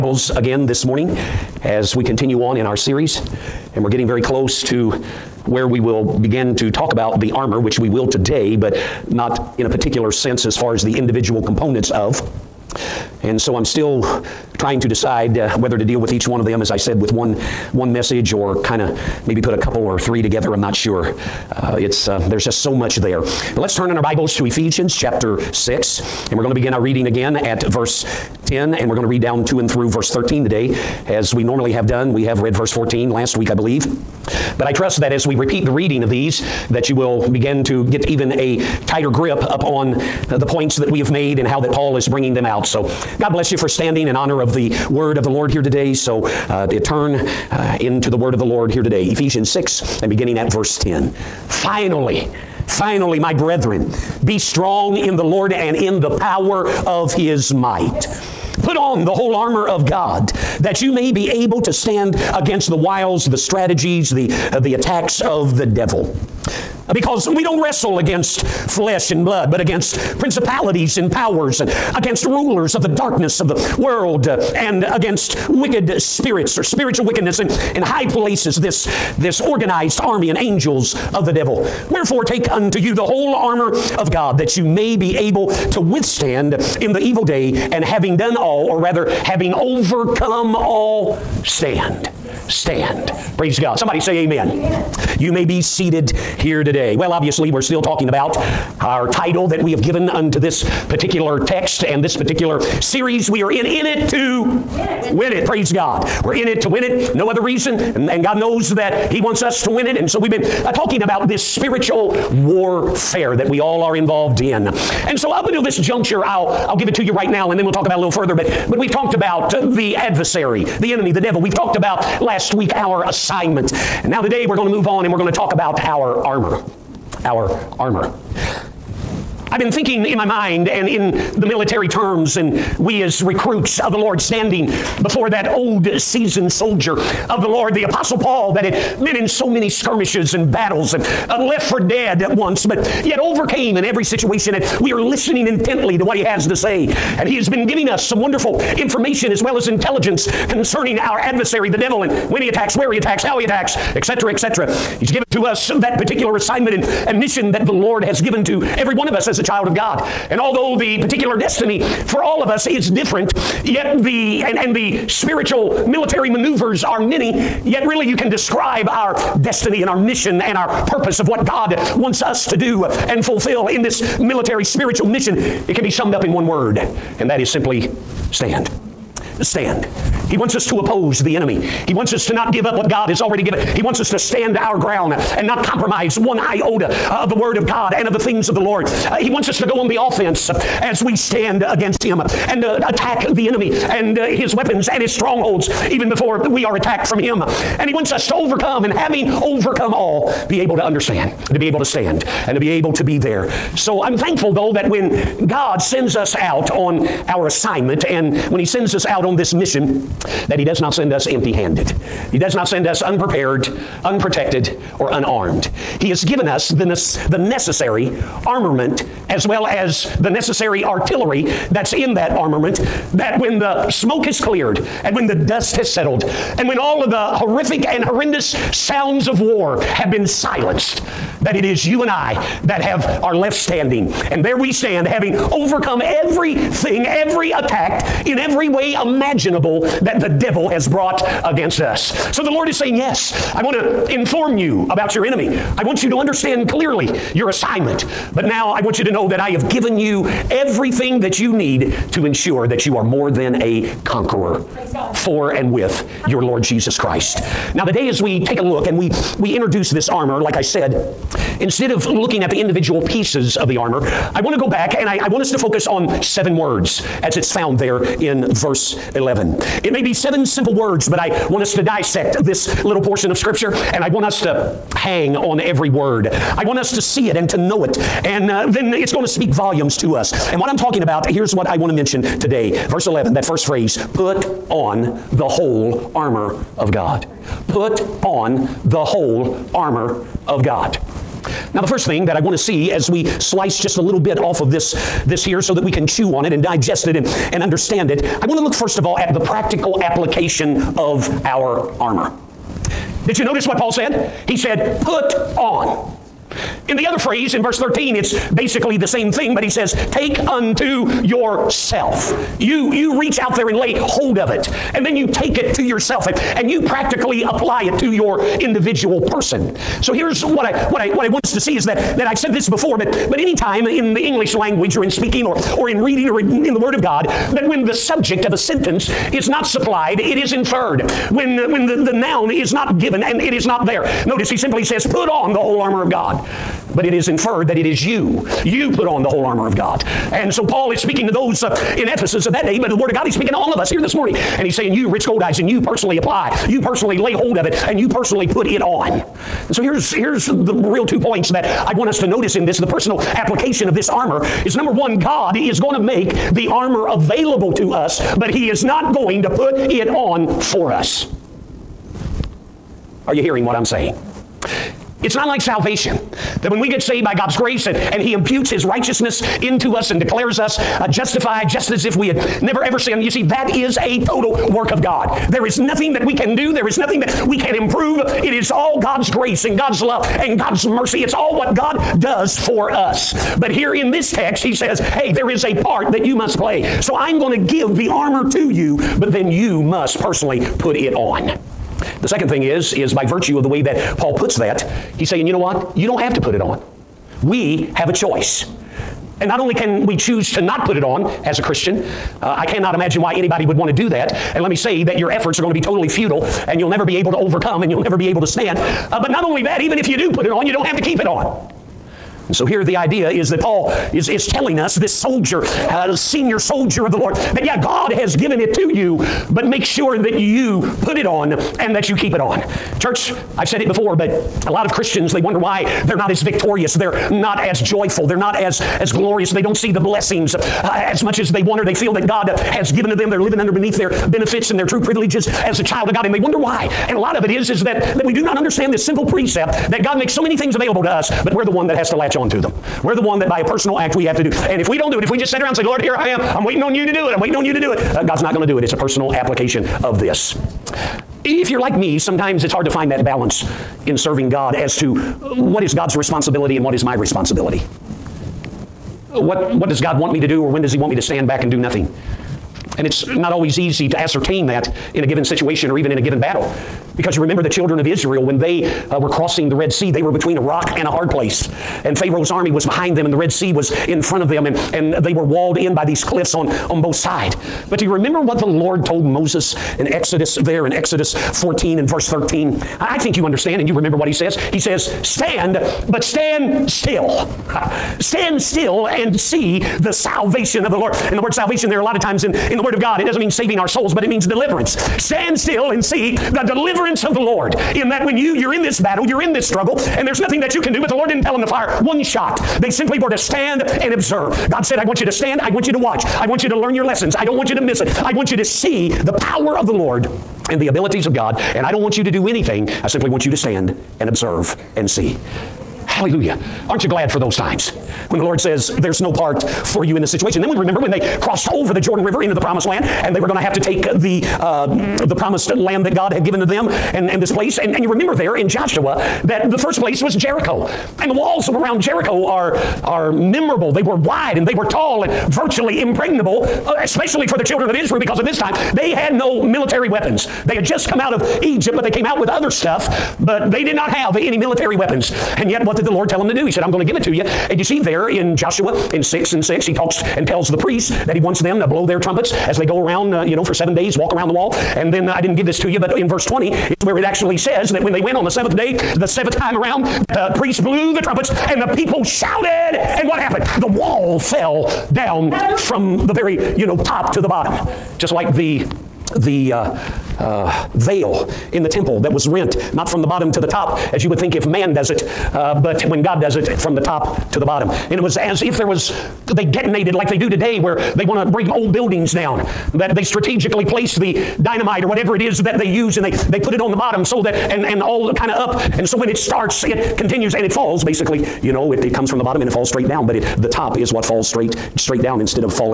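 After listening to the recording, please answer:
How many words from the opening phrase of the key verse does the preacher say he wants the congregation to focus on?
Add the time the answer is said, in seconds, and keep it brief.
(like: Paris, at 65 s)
7, at 266 s.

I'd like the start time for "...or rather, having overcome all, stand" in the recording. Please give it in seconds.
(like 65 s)
88 s.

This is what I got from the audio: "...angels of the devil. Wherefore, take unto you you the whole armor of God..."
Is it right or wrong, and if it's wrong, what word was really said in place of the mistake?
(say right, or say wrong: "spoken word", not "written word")
right.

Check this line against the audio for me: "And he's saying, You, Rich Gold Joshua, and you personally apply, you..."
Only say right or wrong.
wrong.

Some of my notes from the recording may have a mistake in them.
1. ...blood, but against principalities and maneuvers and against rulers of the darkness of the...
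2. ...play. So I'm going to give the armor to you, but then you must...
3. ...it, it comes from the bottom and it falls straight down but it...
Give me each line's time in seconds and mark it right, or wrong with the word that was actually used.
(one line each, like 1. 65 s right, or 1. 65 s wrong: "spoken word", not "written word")
1. 69 s wrong: "powers", not "maneuvers"
2. 386 s right
3. 591 s right.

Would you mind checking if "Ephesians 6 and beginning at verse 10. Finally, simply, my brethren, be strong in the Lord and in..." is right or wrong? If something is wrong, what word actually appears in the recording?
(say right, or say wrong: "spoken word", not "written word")
wrong: "finally", not "simply".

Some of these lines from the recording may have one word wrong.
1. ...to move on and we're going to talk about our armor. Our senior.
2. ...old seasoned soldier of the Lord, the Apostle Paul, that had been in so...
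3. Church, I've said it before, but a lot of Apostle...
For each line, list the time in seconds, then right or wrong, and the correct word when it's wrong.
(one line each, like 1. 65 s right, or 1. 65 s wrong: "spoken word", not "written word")
1. 124 s wrong: "armor", not "senior"
2. 135 s right
3. 422 s wrong: "Christians", not "Apostle".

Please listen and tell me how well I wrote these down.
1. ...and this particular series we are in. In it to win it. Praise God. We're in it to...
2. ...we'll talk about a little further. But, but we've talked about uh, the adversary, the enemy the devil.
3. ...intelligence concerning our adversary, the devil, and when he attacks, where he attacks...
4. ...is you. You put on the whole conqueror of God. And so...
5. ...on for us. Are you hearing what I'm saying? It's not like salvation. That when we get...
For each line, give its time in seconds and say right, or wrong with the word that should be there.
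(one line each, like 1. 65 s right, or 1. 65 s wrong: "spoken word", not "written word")
1. 101 s right
2. 117 s right
3. 149 s right
4. 337 s wrong: "armor", not "conqueror"
5. 360 s right.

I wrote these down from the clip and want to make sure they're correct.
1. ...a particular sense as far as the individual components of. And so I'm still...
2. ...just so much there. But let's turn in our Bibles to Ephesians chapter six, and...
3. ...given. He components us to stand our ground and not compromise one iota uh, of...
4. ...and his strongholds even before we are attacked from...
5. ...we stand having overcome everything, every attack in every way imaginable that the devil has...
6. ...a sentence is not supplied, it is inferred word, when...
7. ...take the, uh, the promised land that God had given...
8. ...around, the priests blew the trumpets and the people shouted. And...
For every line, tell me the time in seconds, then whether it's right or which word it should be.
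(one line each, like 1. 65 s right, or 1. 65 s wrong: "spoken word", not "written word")
1. 9 s right
2. 22 s right
3. 183 s wrong: "wants", not "components"
4. 194 s right
5. 234 s right
6. 328 s right
7. 523 s right
8. 559 s right.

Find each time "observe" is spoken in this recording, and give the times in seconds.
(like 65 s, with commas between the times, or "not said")
504 s, 514 s.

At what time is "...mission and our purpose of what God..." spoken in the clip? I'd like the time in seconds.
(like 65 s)
169 s.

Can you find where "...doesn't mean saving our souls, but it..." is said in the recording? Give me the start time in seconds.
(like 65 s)
493 s.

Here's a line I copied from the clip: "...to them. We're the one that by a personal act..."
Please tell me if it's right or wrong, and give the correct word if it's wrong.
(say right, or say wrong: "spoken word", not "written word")
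right.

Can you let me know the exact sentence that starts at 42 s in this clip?
So God bless you for standing in honor of the word of the Lord here today.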